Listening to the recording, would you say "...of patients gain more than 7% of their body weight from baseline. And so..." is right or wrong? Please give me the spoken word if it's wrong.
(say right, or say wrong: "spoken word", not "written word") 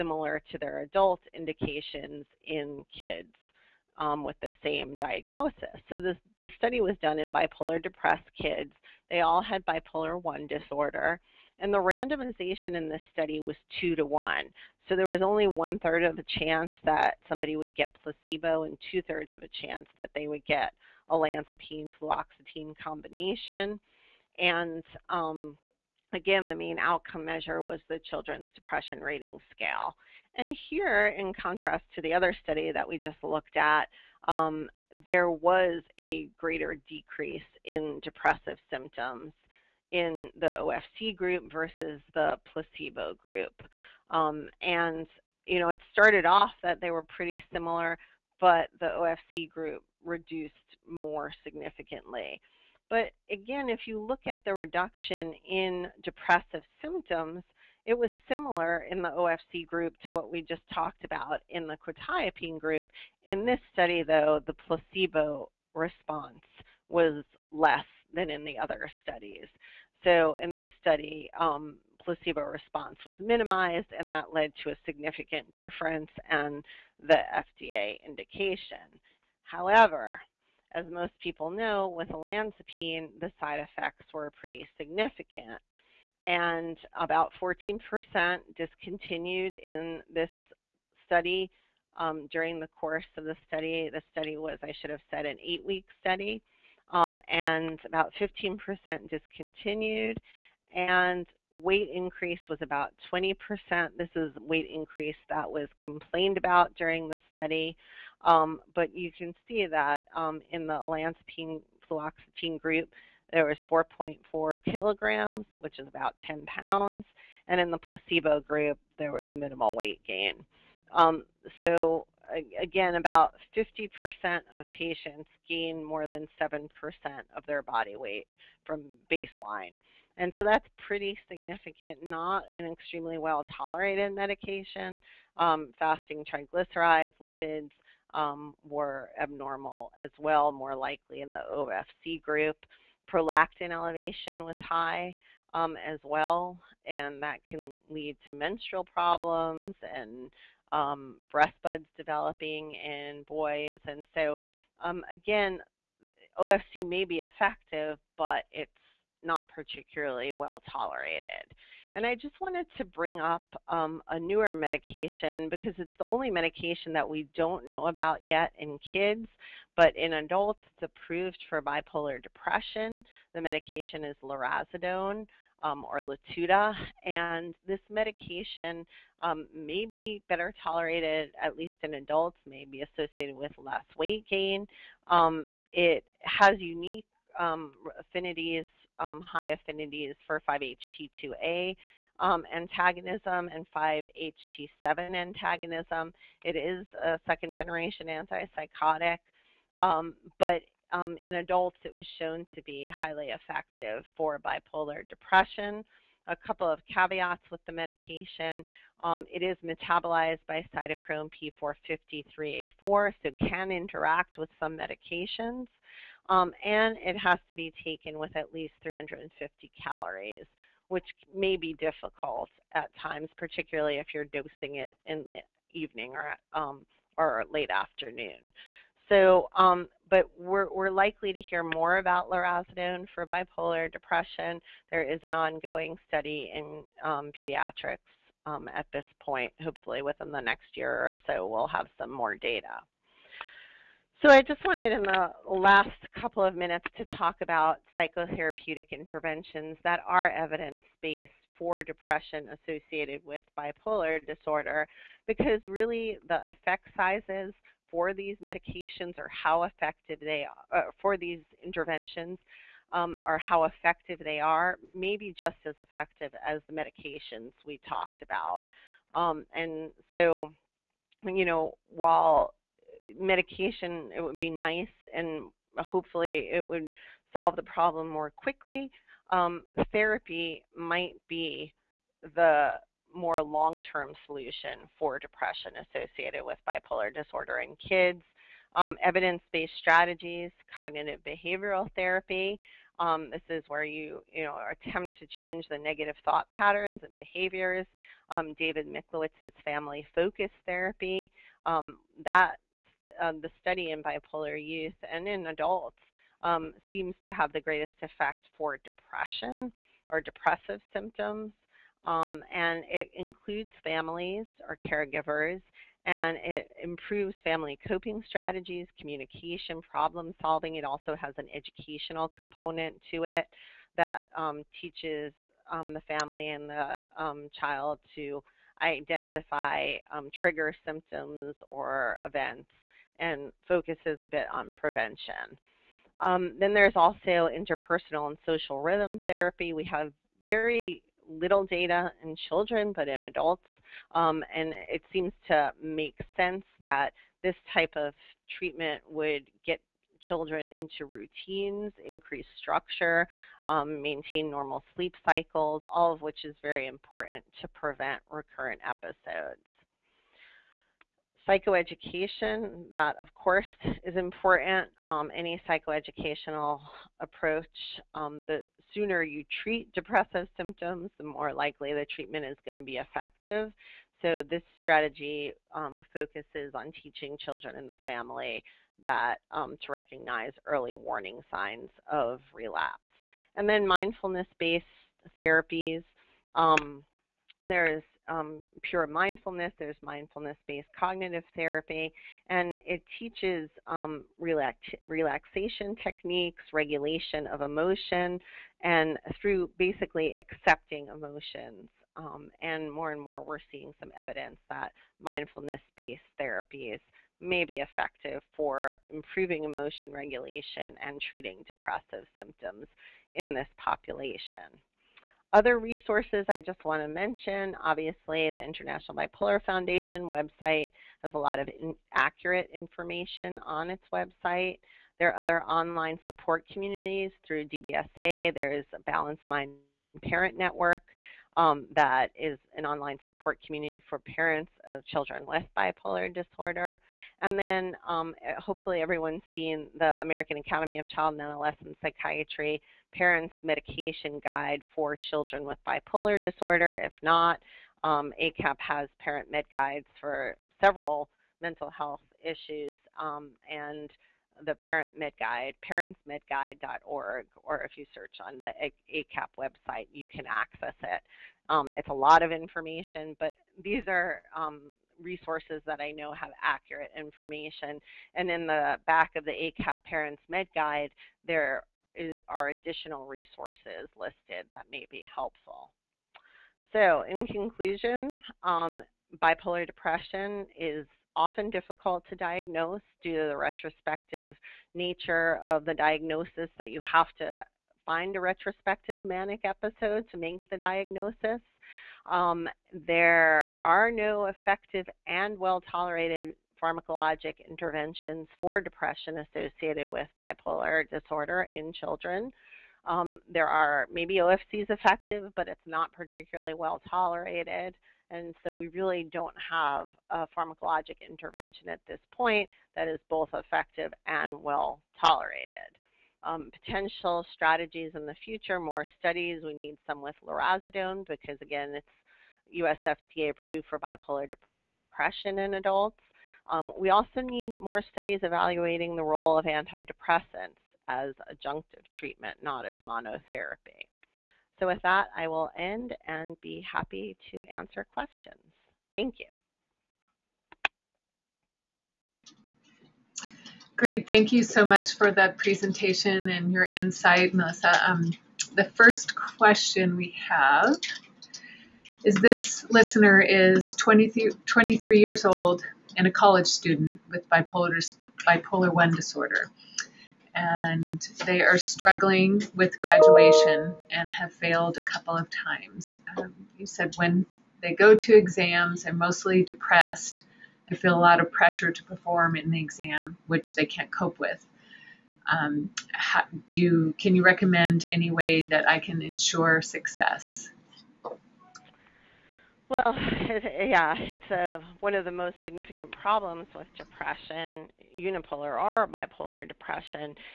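right.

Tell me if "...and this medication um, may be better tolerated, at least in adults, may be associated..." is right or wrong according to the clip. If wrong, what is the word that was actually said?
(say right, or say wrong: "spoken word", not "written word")
right.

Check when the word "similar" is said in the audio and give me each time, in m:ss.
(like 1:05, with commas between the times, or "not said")
0:47, 0:58.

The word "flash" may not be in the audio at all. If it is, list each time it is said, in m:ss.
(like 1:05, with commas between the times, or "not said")
not said.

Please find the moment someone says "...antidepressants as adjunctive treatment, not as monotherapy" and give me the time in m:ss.
8:49.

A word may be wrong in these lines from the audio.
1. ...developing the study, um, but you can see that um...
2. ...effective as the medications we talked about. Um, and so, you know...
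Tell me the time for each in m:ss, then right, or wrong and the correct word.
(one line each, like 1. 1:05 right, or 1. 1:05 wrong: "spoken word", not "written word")
1. 1:46 wrong: "during", not "developing"
2. 4:25 right.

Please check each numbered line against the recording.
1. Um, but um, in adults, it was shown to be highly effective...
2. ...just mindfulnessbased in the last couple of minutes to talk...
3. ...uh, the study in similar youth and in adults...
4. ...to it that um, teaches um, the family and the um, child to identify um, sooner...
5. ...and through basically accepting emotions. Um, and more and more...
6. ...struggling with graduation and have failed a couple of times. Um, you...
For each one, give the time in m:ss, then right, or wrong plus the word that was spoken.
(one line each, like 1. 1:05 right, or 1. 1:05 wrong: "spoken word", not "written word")
1. 3:19 right
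2. 4:04 wrong: "wanted", not "mindfulnessbased"
3. 5:03 wrong: "bipolar", not "similar"
4. 5:23 wrong: "trigger", not "sooner"
5. 6:38 right
6. 9:21 right.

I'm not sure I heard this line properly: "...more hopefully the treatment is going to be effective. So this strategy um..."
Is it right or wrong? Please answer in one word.
wrong.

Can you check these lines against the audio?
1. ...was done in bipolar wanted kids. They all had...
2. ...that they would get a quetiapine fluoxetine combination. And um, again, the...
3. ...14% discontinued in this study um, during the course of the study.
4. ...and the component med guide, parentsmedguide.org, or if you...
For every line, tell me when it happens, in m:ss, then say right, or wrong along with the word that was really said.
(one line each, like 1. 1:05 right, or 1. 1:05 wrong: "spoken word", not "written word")
1. 0:06 wrong: "depressed", not "wanted"
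2. 0:19 wrong: "olanzapine", not "quetiapine"
3. 1:27 right
4. 7:33 wrong: "parent", not "component".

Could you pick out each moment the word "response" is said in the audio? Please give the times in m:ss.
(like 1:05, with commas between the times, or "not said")
1:05, 1:12.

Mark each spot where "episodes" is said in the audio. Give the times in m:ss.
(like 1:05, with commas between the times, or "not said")
5:58, 8:09.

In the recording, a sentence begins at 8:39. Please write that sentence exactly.
We need some with lurasidone because, again, it's US FDA approved for bipolar depression in adults.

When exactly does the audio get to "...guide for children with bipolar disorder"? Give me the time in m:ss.
7:24.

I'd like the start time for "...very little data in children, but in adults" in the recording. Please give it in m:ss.
5:40.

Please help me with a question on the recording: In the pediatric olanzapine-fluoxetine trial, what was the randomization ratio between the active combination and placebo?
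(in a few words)
2 to 1.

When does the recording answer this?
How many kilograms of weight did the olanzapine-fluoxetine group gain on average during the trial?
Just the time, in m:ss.
1:53.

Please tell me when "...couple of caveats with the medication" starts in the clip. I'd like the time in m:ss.
3:26.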